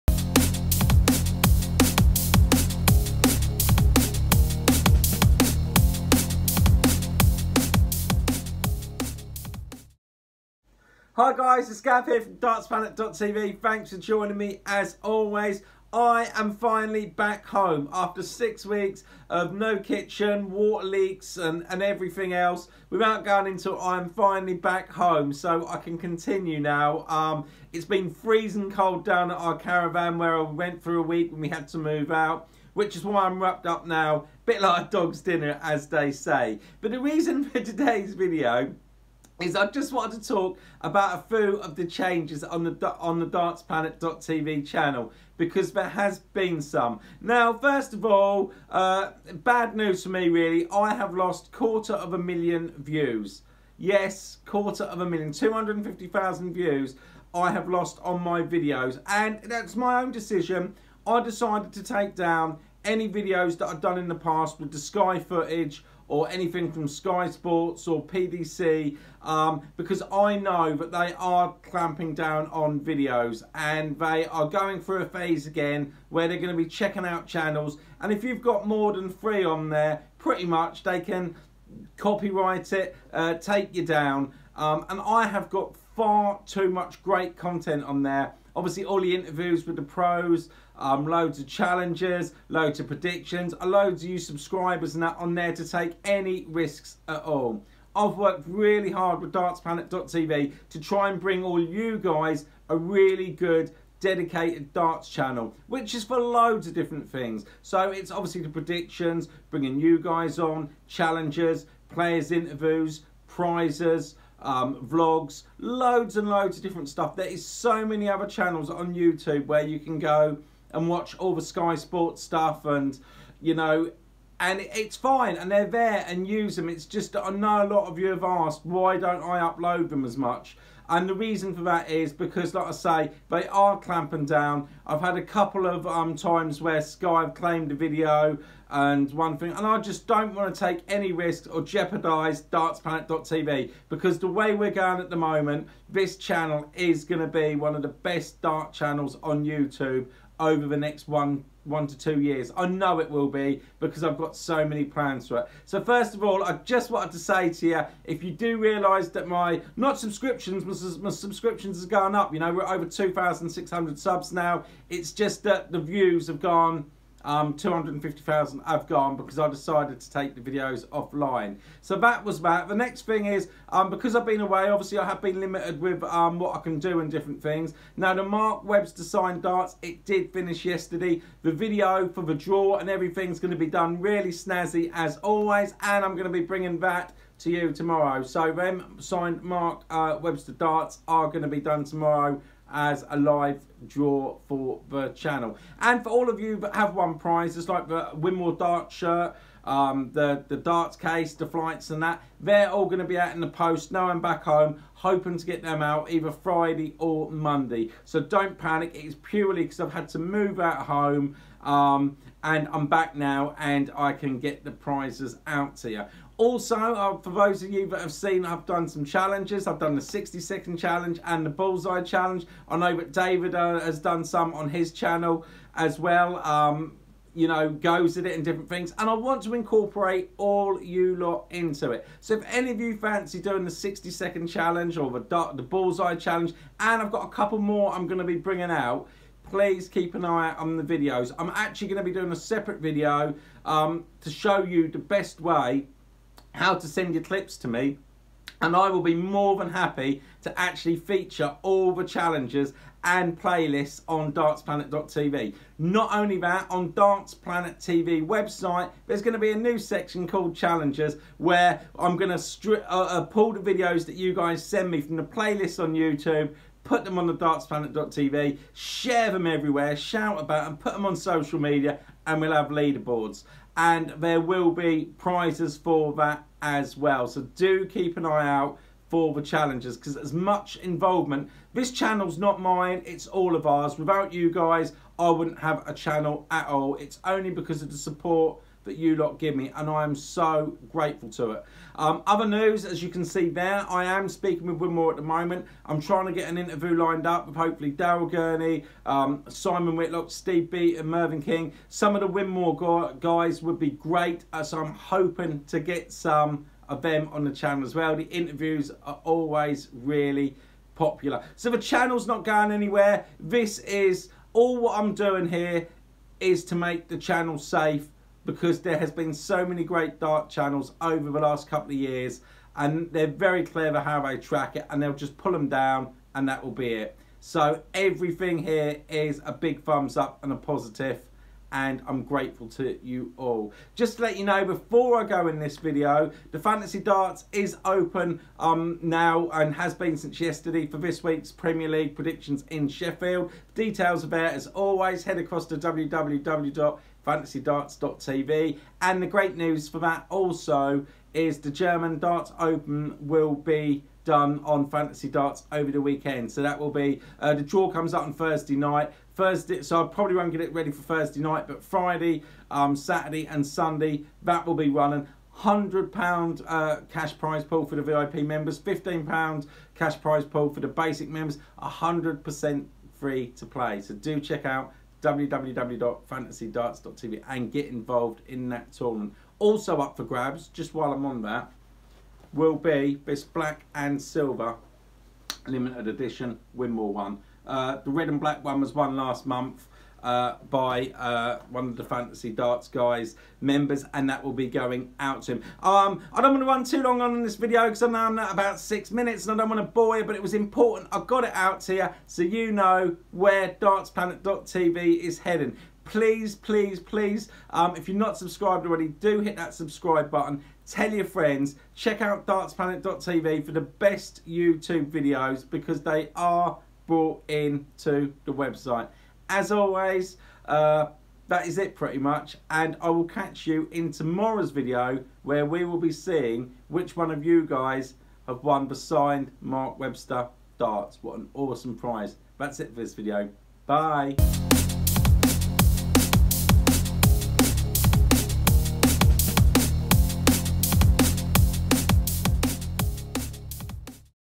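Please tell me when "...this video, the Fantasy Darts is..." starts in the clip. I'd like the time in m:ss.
5:35.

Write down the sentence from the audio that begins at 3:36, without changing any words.
Also, uh, for those of you that have seen, I've done some challenges.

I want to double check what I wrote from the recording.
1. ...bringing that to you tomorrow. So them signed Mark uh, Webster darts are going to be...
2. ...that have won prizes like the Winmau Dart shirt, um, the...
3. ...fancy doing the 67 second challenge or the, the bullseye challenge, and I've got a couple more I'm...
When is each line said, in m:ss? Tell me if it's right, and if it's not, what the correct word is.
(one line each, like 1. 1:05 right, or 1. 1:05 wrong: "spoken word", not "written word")
1. 3:06 right
2. 3:16 right
3. 3:52 wrong: "60", not "67".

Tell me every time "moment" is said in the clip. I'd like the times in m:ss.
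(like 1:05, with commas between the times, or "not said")
2:25, 4:55.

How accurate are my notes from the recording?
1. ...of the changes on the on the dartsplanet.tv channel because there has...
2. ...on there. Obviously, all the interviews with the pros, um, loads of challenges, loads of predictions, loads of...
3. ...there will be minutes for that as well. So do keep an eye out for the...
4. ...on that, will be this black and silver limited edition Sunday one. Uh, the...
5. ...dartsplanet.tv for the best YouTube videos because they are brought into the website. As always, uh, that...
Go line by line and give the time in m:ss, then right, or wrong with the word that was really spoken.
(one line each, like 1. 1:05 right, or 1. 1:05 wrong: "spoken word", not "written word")
1. 0:41 right
2. 1:27 right
3. 4:34 wrong: "prizes", not "minutes"
4. 6:21 wrong: "Winmau", not "Sunday"
5. 6:52 right.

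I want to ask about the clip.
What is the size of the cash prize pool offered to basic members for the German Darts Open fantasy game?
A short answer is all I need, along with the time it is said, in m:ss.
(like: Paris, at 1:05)
£15, at 6:08.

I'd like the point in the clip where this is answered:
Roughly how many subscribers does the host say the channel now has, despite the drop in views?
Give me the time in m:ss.
2:42.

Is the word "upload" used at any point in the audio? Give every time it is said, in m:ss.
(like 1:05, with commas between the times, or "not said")
2:09.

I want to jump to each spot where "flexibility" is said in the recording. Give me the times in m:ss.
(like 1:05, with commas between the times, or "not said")
not said.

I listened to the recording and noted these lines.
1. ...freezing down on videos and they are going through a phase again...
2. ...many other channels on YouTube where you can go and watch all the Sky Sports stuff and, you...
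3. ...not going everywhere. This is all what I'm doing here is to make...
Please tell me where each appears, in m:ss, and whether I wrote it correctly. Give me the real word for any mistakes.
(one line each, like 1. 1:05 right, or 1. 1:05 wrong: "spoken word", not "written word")
1. 1:11 wrong: "clamping", not "freezing"
2. 1:57 right
3. 5:12 wrong: "anywhere", not "everywhere".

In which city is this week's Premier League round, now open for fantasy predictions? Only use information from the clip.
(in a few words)
Sheffield.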